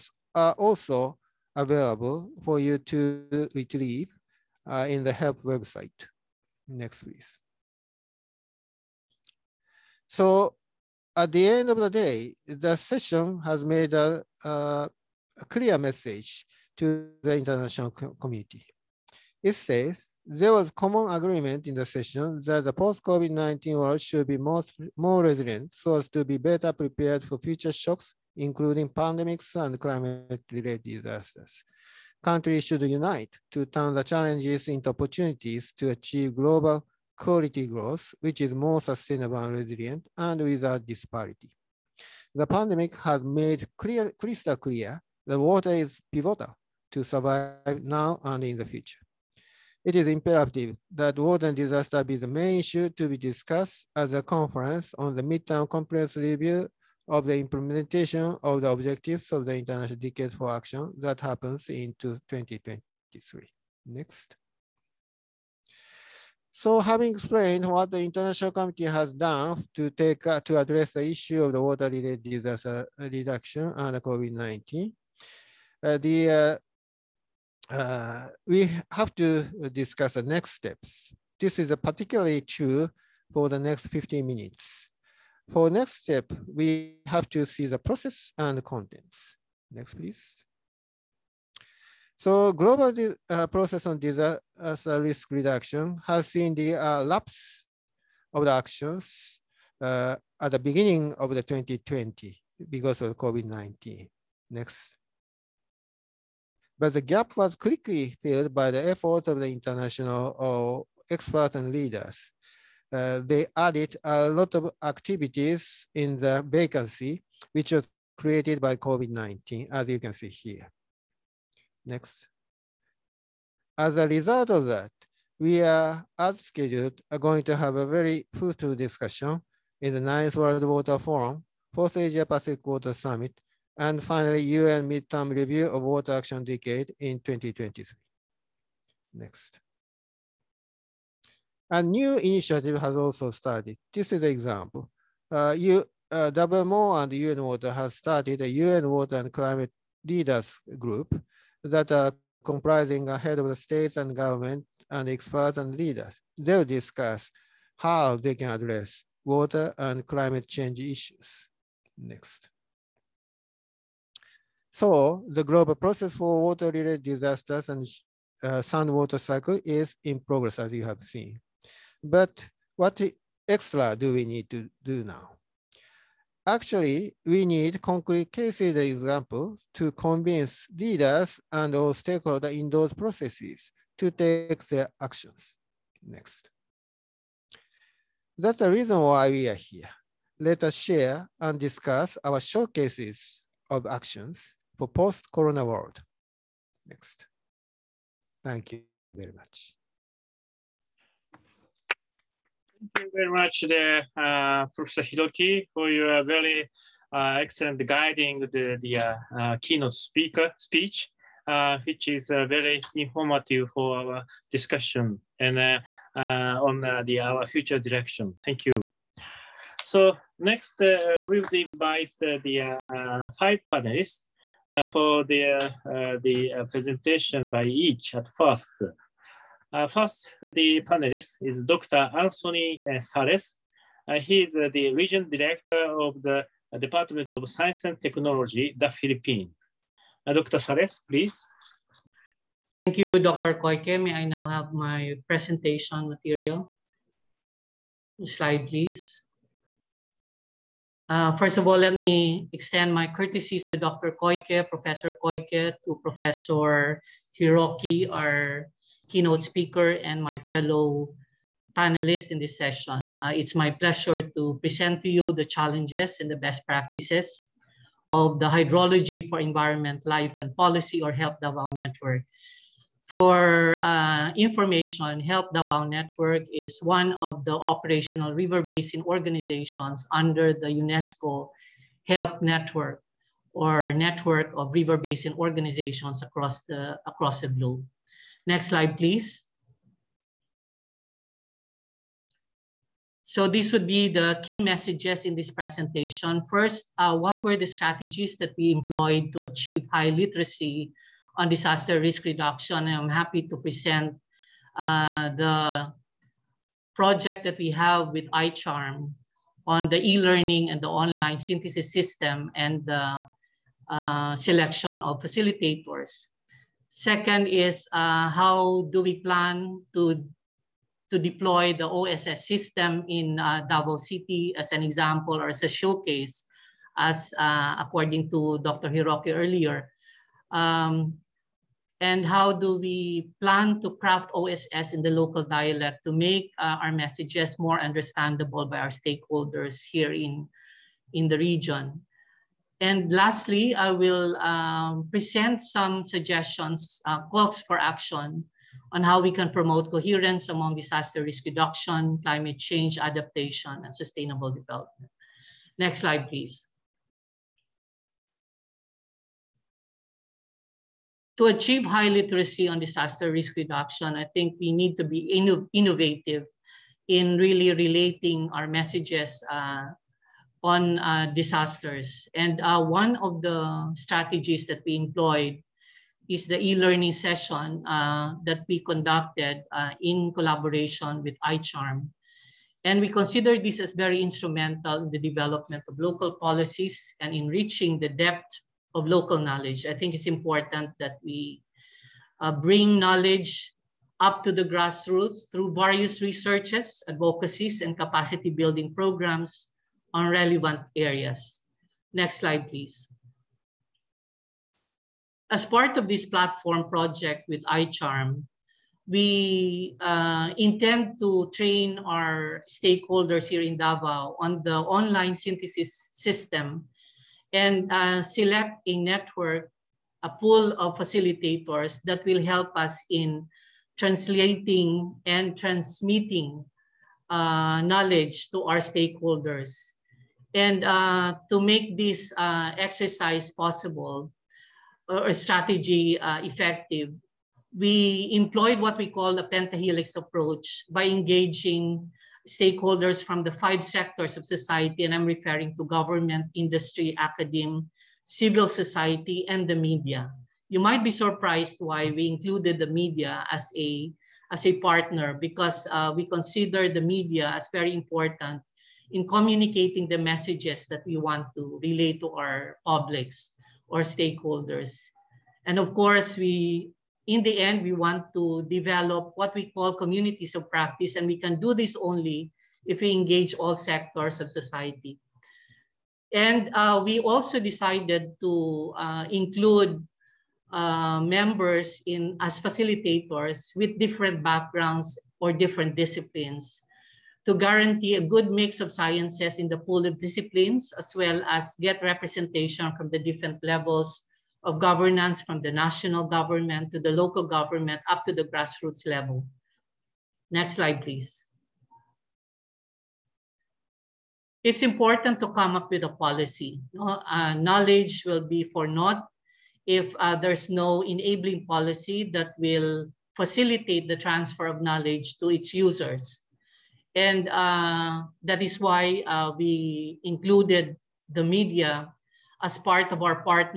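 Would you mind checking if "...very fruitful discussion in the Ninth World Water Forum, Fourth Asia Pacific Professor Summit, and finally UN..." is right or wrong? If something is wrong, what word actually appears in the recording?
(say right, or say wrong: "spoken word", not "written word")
wrong: "Water", not "Professor".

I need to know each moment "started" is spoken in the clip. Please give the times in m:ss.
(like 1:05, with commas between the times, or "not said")
2:23, 2:27.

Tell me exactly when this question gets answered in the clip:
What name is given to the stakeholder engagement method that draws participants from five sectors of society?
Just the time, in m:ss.
7:19.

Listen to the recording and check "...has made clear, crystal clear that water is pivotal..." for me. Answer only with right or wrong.
right.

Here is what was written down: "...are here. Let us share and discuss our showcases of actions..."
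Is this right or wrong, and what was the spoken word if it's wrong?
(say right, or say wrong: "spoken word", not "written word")
right.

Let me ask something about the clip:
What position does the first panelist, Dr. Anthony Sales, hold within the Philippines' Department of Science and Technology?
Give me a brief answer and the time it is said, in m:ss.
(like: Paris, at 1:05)
Region director, at 3:54.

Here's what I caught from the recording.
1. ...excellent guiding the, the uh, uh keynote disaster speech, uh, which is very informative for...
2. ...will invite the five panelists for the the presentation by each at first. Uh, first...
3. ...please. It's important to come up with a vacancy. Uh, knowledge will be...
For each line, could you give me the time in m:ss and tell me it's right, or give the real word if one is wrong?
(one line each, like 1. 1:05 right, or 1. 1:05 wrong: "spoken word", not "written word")
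1. 3:27 wrong: "speaker", not "disaster"
2. 3:41 right
3. 8:21 wrong: "policy", not "vacancy".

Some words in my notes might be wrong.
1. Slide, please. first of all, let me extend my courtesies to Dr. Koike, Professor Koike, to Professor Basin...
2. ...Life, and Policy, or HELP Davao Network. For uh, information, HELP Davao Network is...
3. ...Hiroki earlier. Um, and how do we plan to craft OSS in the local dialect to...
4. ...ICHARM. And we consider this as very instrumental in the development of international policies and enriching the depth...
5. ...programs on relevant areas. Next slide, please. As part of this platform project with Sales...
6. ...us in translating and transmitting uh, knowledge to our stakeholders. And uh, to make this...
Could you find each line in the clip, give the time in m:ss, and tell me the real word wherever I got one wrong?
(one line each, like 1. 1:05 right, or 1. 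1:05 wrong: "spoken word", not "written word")
1. 4:08 wrong: "Hiroki", not "Basin"
2. 4:30 right
3. 5:28 right
4. 6:21 wrong: "local", not "international"
5. 6:38 wrong: "ICHARM", not "Sales"
6. 7:02 right.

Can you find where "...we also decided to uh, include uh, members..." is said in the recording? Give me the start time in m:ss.
7:57.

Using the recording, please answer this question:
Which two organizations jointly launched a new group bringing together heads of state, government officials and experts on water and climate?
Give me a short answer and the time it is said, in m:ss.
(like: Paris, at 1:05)
WMO and UN Water, at 2:26.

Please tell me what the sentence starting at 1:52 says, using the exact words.
Uh, they added a lot of activities in the vacancy, which was created by COVID-19, as you can see here.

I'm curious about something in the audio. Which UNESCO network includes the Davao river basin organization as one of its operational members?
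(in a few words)
UNESCO HELP Network.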